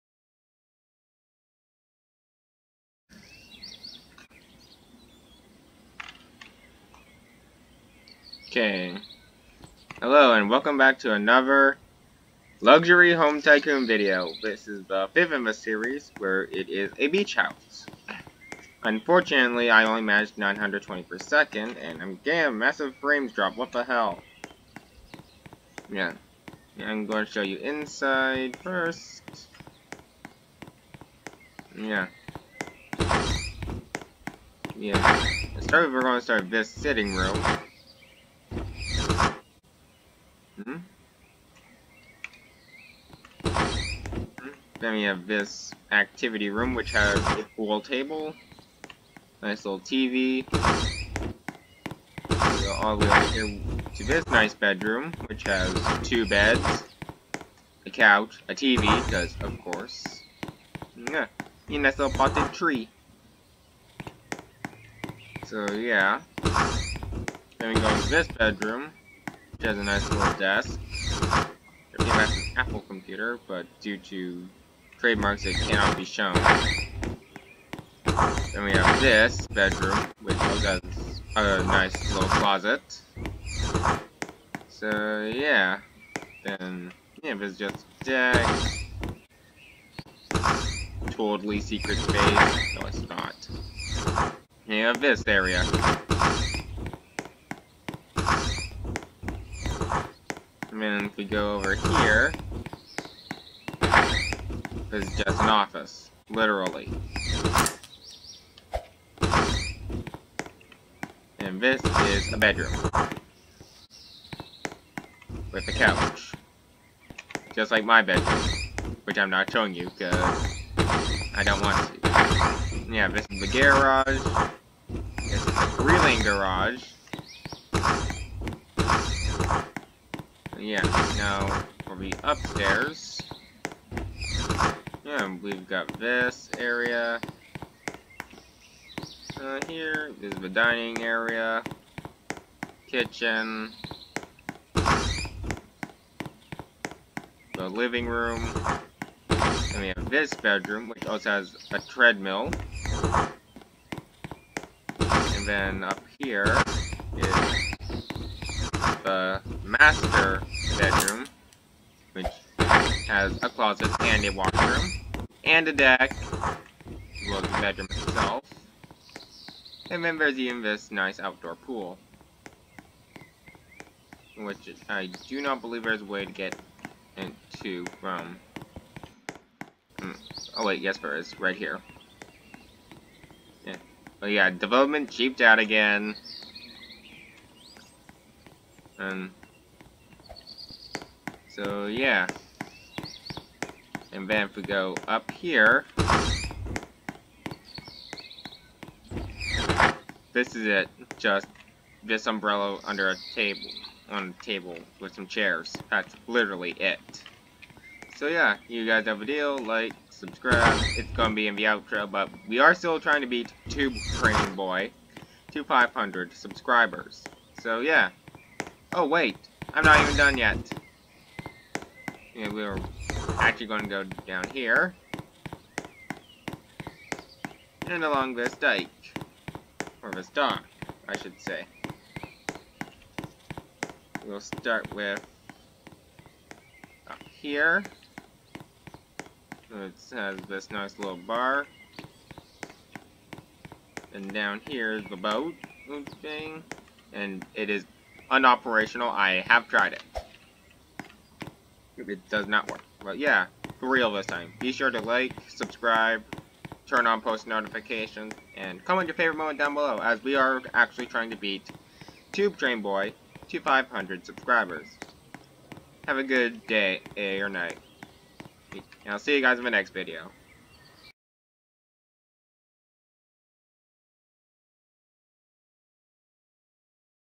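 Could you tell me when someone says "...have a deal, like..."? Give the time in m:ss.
3:29.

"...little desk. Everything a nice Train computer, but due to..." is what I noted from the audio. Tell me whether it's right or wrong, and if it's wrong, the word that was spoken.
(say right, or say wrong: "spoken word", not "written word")
wrong: "Apple", not "Train".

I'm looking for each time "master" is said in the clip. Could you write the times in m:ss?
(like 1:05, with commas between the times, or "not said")
2:39.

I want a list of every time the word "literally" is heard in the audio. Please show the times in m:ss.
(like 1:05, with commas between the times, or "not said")
1:46, 3:26.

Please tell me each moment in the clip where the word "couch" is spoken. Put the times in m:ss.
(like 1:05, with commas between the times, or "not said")
0:57, 1:55.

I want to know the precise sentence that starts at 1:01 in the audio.
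Yeah, a nice little potted tree.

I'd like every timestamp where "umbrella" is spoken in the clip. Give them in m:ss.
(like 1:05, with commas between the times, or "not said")
3:22.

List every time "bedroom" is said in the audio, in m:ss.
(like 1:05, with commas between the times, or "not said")
0:54, 1:08, 1:19, 1:52, 1:58, 2:30, 2:40, 2:47.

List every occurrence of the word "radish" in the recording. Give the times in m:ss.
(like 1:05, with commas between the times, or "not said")
not said.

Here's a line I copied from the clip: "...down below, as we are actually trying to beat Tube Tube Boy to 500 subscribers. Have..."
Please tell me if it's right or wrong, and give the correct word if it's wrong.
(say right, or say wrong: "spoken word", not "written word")
wrong: "Train", not "Tube".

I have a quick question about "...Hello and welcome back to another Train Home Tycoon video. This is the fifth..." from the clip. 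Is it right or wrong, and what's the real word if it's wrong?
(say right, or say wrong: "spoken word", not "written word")
wrong: "Luxury", not "Train".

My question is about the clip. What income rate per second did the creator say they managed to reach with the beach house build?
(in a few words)
920.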